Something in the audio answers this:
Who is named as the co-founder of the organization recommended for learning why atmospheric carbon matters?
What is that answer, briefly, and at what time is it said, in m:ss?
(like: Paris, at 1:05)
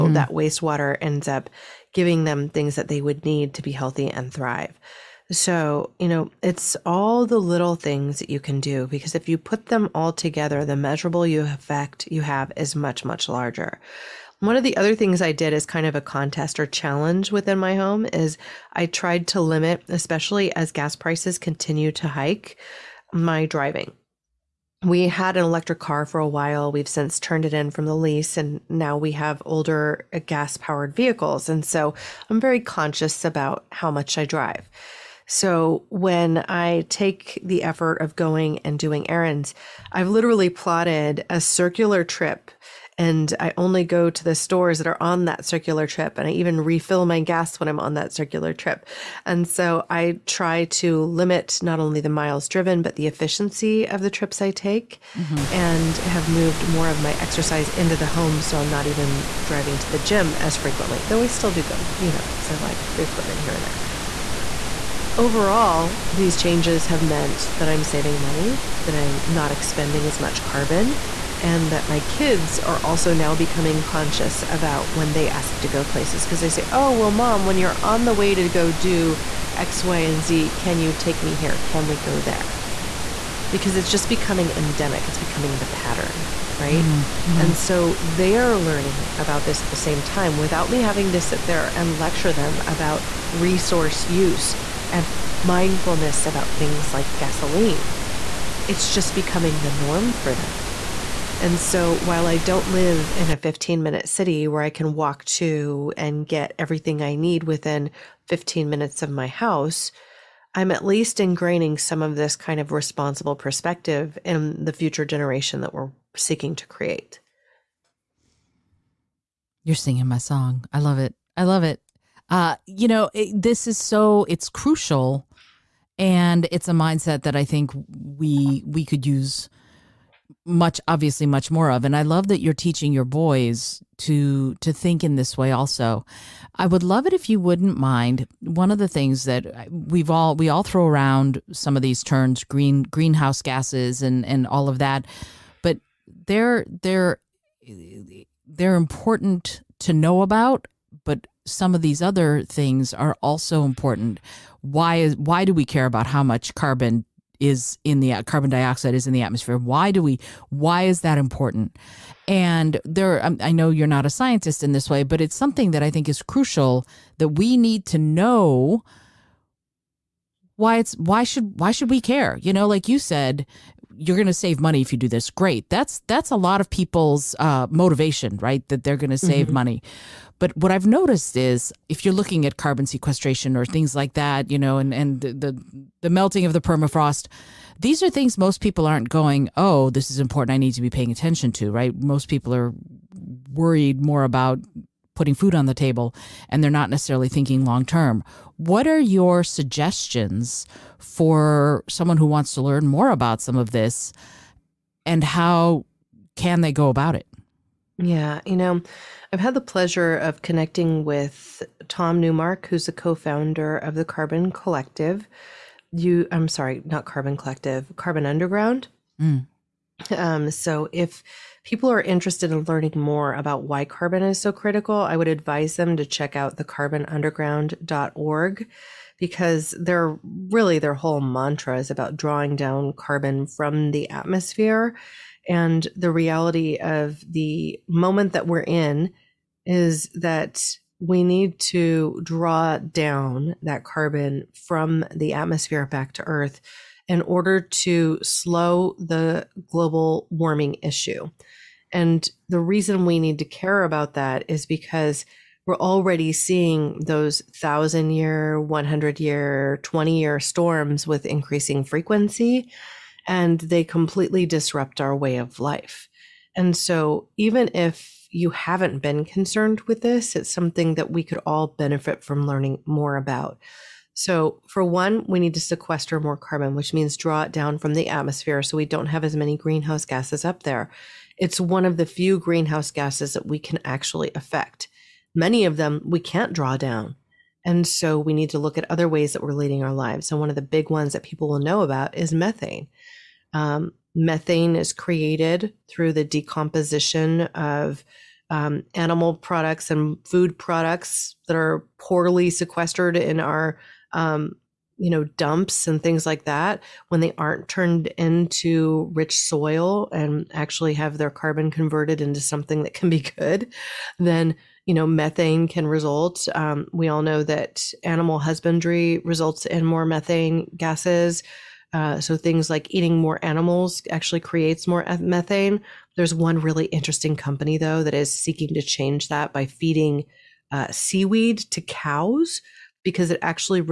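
Tom Newmark, at 3:31.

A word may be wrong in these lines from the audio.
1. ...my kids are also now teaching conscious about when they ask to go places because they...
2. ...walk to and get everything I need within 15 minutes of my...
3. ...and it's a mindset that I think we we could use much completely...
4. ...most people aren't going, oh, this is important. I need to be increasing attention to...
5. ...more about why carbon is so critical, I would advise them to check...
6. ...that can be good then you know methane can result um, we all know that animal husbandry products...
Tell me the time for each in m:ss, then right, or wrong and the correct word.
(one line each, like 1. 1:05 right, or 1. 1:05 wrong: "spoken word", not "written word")
1. 1:11 wrong: "becoming", not "teaching"
2. 1:44 right
3. 2:05 wrong: "obviously", not "completely"
4. 3:08 wrong: "paying", not "increasing"
5. 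3:42 right
6. 5:12 wrong: "results", not "products".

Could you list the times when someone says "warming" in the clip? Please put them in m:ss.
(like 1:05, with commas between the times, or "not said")
4:10.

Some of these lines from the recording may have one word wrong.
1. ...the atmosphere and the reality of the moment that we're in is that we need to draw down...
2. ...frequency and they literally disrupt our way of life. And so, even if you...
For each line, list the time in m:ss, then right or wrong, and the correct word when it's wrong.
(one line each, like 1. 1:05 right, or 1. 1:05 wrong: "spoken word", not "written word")
1. 3:53 right
2. 4:21 wrong: "completely", not "literally".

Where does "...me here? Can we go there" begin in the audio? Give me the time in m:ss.
1:21.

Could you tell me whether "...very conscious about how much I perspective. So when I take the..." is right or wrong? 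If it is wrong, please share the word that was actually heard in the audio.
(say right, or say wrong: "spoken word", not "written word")
wrong: "drive", not "perspective".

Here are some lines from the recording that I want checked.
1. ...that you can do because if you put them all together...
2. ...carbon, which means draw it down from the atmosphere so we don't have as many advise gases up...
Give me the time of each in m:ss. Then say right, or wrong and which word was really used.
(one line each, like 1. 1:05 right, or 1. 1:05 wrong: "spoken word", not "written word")
1. 0:08 right
2. 4:36 wrong: "greenhouse", not "advise".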